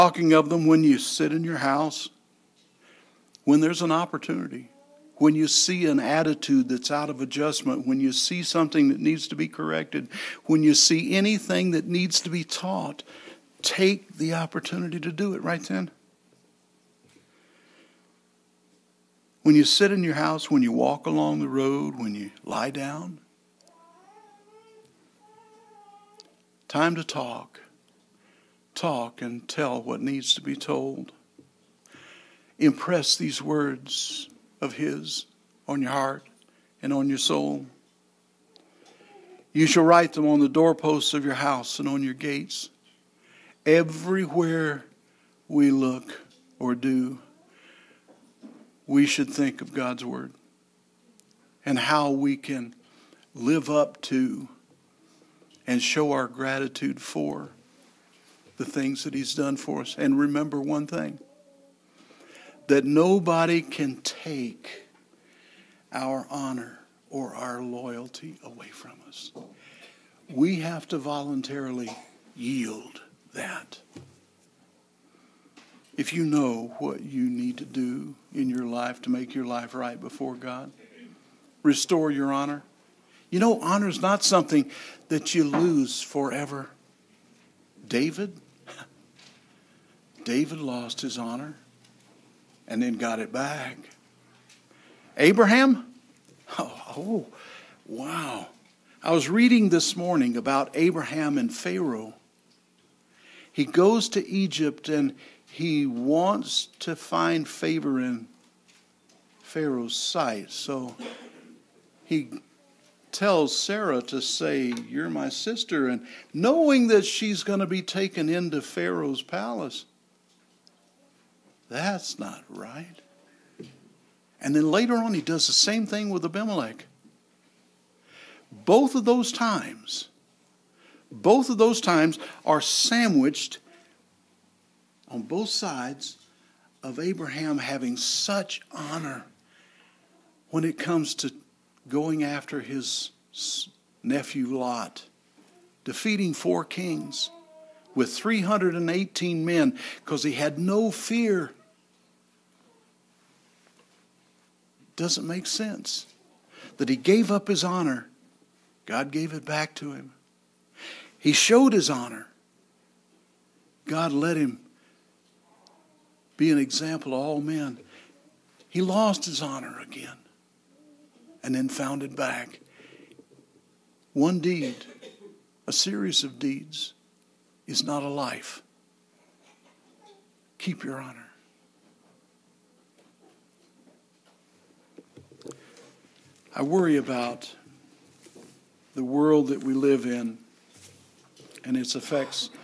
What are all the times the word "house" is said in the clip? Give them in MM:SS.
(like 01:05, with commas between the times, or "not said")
00:01, 00:20, 00:41.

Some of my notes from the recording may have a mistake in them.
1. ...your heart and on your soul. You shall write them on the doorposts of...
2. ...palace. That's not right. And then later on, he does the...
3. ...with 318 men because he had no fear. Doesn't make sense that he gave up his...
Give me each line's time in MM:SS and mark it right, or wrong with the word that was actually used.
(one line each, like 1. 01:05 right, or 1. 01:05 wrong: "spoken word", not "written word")
1. 00:35 right
2. 01:59 right
3. 02:27 right.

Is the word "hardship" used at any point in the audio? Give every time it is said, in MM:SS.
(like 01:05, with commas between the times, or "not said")
not said.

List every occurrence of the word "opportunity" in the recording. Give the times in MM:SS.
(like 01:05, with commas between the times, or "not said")
00:03, 00:14.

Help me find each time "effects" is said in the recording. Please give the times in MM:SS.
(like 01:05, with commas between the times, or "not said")
03:11.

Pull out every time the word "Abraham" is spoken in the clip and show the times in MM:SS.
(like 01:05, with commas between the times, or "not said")
01:35, 01:40, 02:16.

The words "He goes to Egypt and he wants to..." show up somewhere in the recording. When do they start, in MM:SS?
01:43.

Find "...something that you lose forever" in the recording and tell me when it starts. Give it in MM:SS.
01:24.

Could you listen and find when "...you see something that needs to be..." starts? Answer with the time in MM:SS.
00:08.